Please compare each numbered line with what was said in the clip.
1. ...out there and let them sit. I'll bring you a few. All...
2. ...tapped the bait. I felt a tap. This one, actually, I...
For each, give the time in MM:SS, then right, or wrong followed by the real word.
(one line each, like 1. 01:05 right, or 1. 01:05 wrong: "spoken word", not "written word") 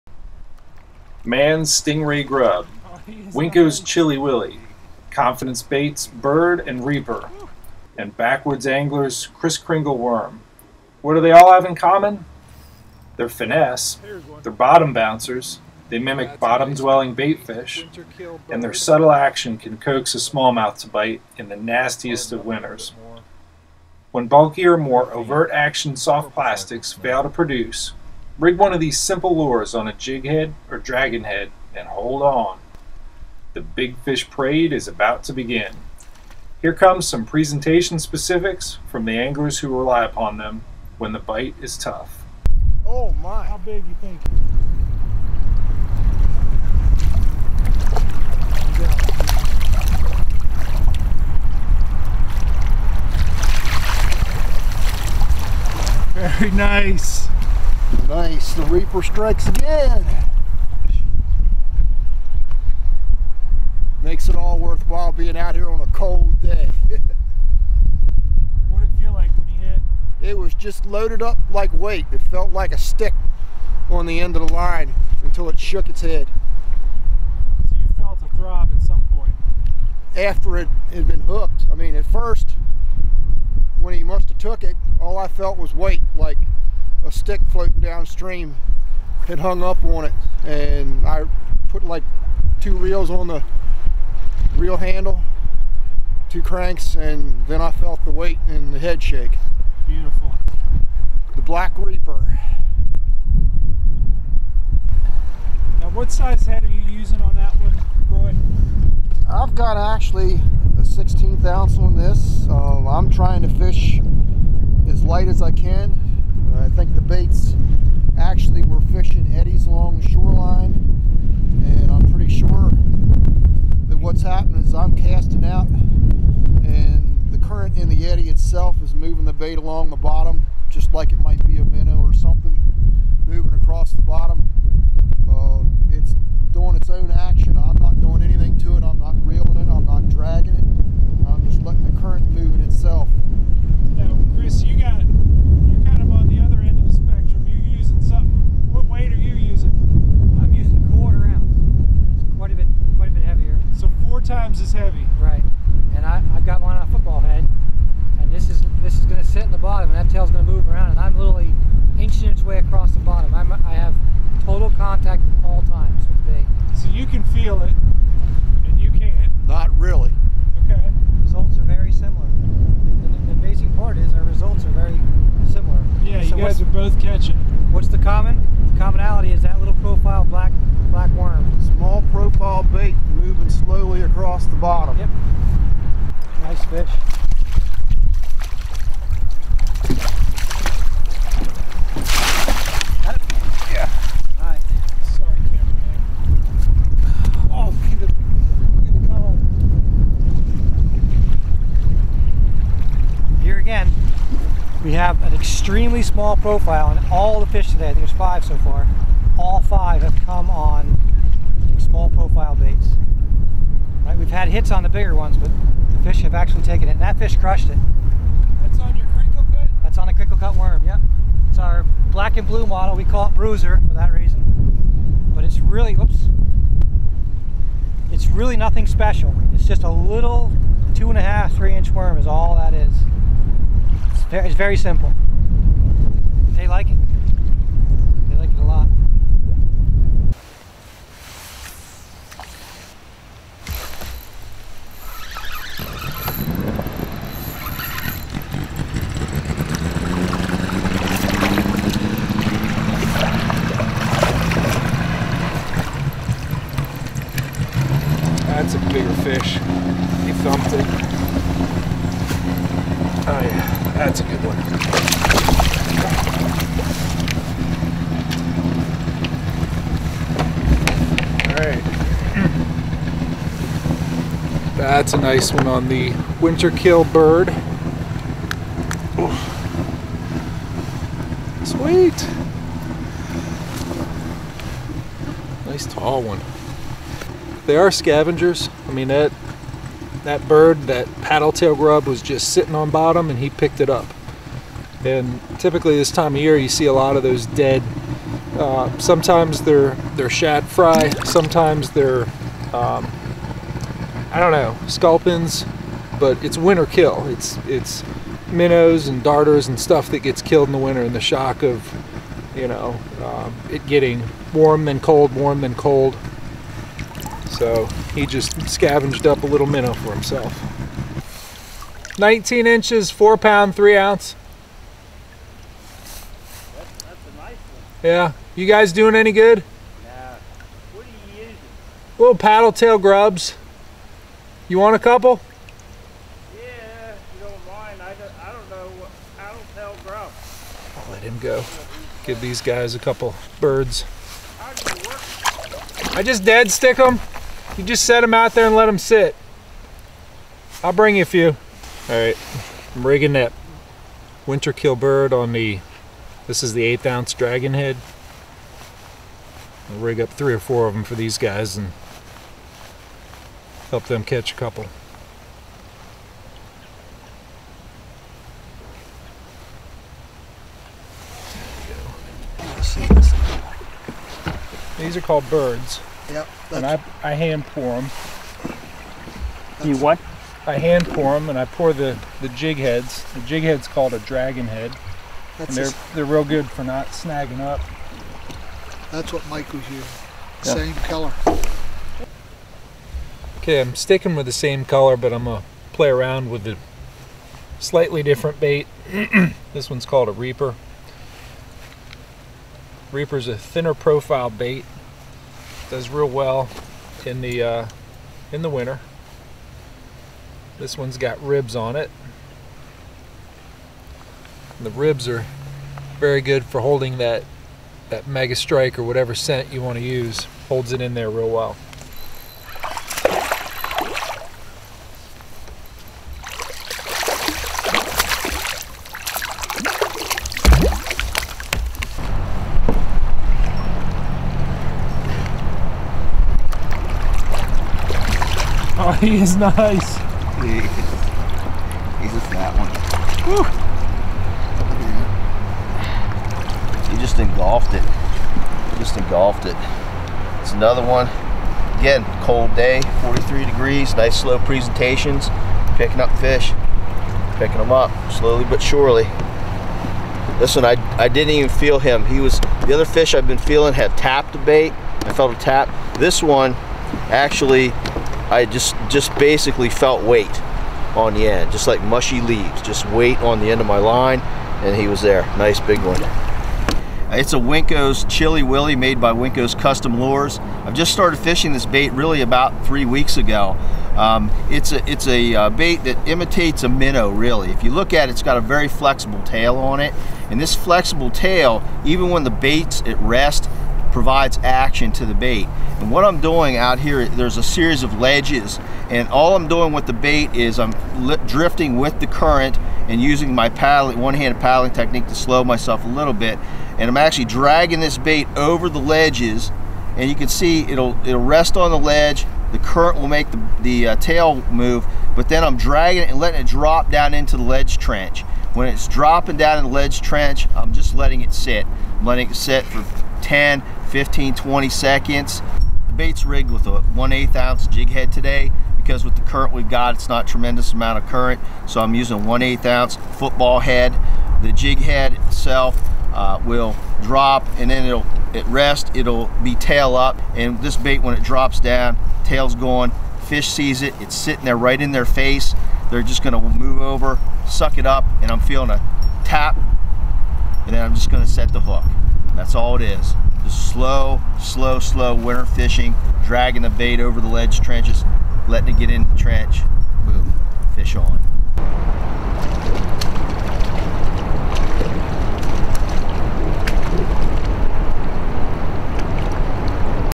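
1. 05:48 right
2. 07:44 right.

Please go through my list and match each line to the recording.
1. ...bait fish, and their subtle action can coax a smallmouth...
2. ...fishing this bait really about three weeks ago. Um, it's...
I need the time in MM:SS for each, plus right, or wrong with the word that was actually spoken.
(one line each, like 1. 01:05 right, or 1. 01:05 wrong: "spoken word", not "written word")
1. 00:17 right
2. 08:01 right.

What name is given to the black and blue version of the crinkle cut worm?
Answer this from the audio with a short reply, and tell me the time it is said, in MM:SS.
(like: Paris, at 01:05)
Bruiser, at 03:43.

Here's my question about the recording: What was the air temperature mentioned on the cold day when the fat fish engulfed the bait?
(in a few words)
43 degrees.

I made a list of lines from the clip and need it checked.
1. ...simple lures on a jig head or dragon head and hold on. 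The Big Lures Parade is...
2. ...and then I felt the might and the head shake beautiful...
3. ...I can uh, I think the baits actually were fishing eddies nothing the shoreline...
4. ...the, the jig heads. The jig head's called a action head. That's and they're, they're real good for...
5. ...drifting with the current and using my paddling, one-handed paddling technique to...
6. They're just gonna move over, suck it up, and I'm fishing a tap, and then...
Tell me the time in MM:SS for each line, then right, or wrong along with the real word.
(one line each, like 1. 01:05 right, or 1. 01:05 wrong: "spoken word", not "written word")
1. 00:28 wrong: "Fish", not "Lures"
2. 01:36 wrong: "weight", not "might"
3. 01:55 wrong: "along", not "nothing"
4. 06:21 wrong: "dragon", not "action"
5. 08:21 right
6. 09:06 wrong: "feeling", not "fishing".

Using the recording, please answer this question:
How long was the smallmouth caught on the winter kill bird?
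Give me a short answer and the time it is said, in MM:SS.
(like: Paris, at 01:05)
19 inches, at 05:22.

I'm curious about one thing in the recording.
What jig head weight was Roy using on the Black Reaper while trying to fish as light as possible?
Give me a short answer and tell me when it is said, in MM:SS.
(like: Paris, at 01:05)
1/16 ounce, at 01:50.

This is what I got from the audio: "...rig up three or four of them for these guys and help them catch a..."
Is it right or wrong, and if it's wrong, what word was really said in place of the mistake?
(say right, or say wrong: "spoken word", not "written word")
right.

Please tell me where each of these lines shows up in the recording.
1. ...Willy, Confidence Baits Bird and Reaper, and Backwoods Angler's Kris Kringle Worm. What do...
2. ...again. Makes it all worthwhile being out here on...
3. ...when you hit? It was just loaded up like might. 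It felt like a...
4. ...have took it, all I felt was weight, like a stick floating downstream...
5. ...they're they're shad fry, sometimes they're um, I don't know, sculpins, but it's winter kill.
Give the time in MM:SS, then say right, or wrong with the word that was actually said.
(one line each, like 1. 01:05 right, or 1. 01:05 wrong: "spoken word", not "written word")
1. 00:04 right
2. 00:59 right
3. 01:09 wrong: "weight", not "might"
4. 01:24 right
5. 04:59 right.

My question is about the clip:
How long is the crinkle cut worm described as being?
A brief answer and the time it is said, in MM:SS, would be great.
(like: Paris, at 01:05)
2.5 to 3 inches, at 03:50.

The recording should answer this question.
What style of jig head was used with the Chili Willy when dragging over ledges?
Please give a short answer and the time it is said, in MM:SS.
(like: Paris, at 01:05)
Football head, at 08:53.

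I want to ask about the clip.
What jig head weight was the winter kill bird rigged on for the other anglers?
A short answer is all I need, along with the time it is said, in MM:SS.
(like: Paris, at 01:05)
1/8 ounce, at 05:56.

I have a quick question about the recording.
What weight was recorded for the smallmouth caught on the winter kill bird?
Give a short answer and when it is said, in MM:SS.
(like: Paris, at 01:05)
4 pounds 3 ounces, at 05:23.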